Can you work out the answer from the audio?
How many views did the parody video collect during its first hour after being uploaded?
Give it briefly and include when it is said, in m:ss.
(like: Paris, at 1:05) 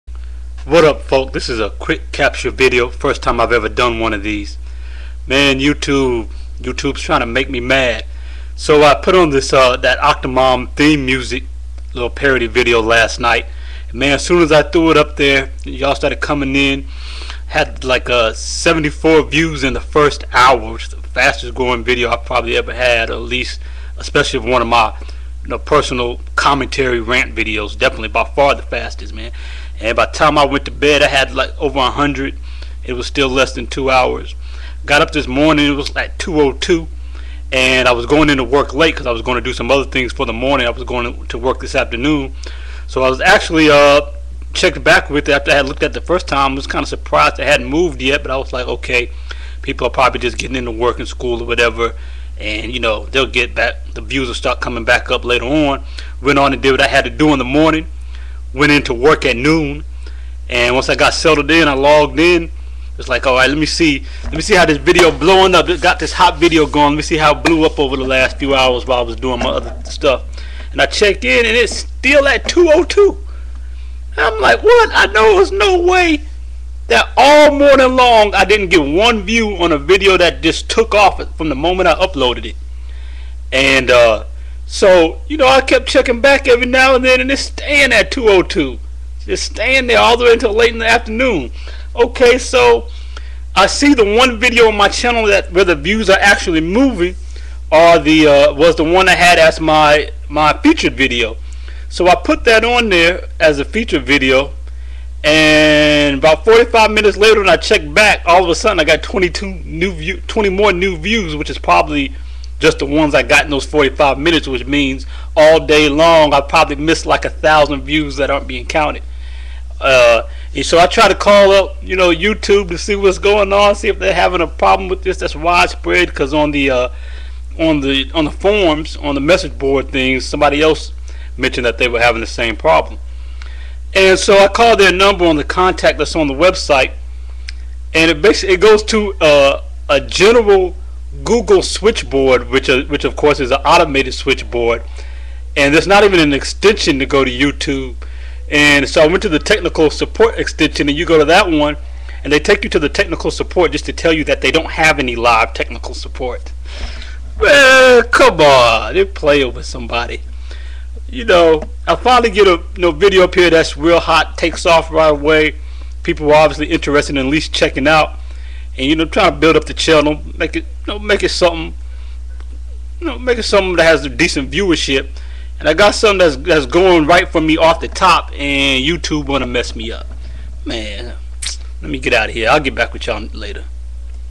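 74, at 0:18.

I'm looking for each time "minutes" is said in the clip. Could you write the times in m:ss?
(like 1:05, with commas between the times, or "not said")
1:46, 1:54.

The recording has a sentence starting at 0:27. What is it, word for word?
Definitely by far the fastest, man.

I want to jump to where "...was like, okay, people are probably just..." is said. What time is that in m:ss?
0:48.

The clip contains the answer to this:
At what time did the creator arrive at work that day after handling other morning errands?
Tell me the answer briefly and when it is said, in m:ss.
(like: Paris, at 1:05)
noon, at 0:59.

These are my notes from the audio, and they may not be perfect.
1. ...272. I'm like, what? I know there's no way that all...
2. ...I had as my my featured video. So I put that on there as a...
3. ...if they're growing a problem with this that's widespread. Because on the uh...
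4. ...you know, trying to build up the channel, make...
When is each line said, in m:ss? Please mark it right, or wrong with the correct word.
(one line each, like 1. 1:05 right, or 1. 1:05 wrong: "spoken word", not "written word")
1. 1:12 wrong: "202", not "272"
2. 1:39 right
3. 2:03 wrong: "having", not "growing"
4. 2:48 right.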